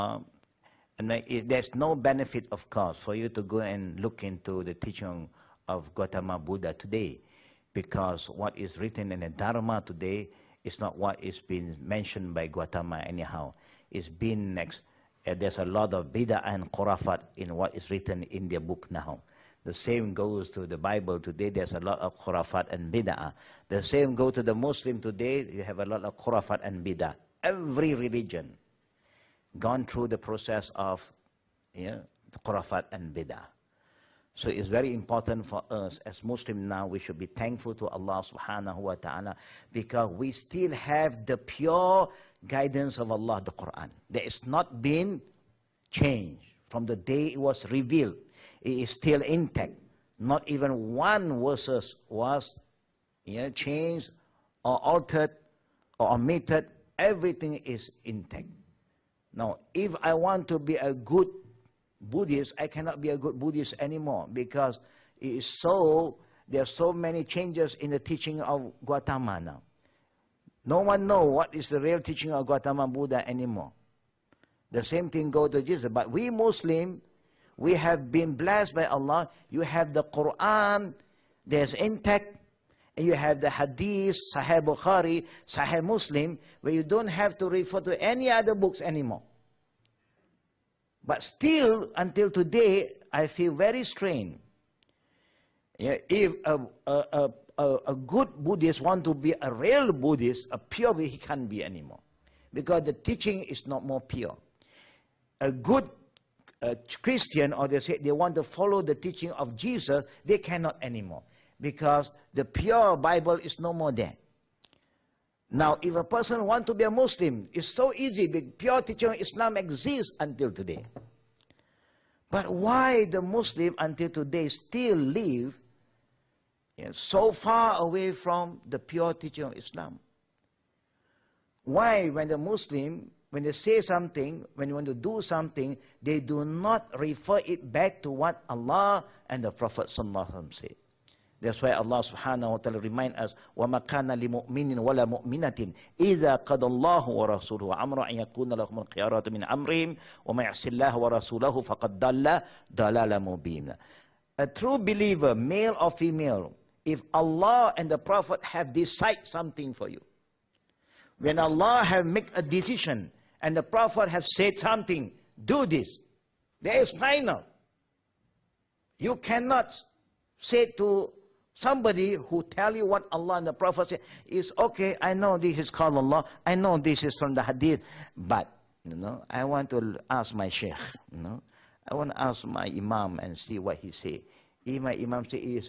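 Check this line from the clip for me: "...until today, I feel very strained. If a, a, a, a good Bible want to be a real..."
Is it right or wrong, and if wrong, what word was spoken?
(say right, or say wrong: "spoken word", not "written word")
wrong: "Buddhist", not "Bible".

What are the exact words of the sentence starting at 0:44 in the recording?
There is not been changed from the day it was revealed.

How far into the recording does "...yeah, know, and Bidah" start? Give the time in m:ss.
0:31.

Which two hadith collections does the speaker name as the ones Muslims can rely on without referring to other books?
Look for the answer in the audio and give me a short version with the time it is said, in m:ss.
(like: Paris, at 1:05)
Sahih Bukhari, Sahih Muslim, at 1:24.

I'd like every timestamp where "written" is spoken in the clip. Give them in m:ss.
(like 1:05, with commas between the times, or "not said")
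0:08, 0:17.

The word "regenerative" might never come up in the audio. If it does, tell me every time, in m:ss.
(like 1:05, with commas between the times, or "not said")
not said.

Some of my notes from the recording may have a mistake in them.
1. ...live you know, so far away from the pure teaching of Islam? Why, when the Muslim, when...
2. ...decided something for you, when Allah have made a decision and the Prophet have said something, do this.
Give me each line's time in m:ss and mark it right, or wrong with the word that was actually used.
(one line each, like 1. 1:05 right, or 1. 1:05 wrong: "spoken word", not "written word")
1. 2:04 right
2. 2:38 right.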